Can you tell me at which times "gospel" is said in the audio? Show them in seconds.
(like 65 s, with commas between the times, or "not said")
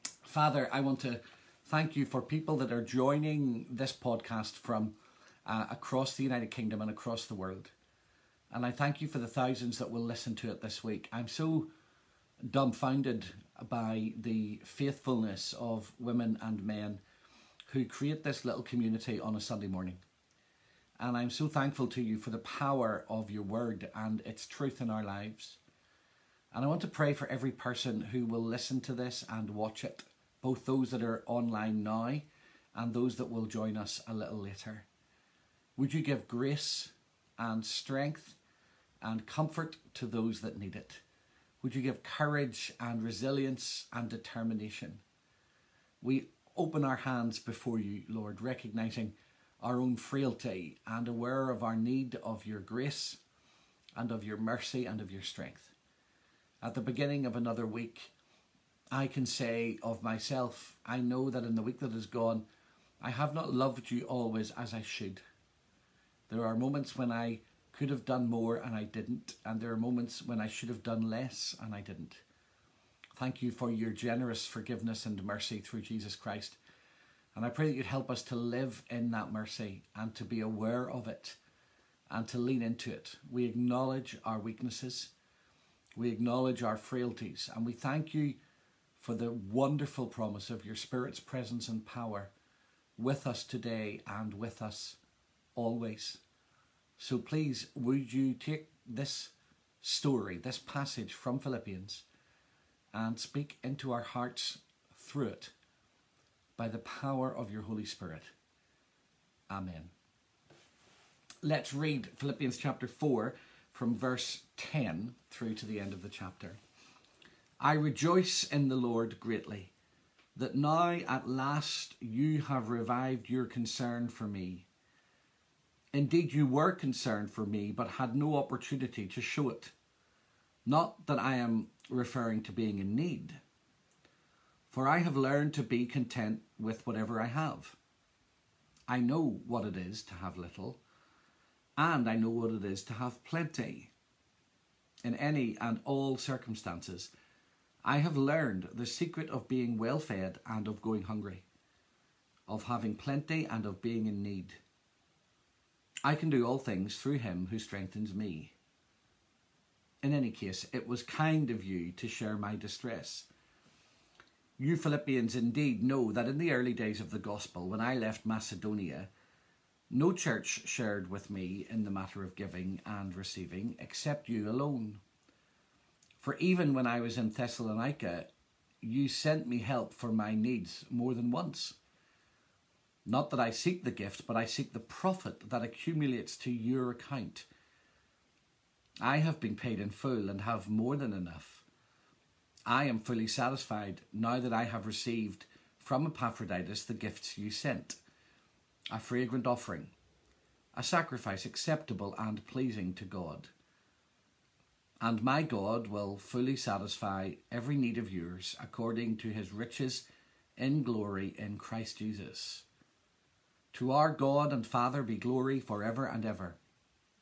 167 s.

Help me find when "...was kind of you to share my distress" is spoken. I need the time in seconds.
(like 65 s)
160 s.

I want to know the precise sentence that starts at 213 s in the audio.
To our God and Father be glory forever and ever.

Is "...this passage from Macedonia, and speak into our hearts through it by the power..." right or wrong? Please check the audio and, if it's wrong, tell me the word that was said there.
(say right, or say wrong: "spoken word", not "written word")
wrong: "Philippians", not "Macedonia".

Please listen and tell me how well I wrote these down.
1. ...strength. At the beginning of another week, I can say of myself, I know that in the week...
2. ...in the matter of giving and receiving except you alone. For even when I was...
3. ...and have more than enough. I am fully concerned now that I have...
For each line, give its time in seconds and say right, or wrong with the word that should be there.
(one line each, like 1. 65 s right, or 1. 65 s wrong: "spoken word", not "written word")
1. 55 s right
2. 171 s right
3. 190 s wrong: "satisfied", not "concerned".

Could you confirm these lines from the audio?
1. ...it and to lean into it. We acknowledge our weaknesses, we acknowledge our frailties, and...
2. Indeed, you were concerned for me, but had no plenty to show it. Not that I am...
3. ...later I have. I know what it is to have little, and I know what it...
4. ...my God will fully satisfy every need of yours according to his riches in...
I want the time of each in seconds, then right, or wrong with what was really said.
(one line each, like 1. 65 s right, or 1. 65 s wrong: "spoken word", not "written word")
1. 81 s right
2. 125 s wrong: "opportunity", not "plenty"
3. 136 s wrong: "whatever", not "later"
4. 205 s right.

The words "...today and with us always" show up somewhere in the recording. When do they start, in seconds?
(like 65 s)
93 s.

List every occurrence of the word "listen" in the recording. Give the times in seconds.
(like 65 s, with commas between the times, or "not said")
10 s, 28 s.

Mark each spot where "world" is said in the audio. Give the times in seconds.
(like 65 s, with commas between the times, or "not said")
7 s.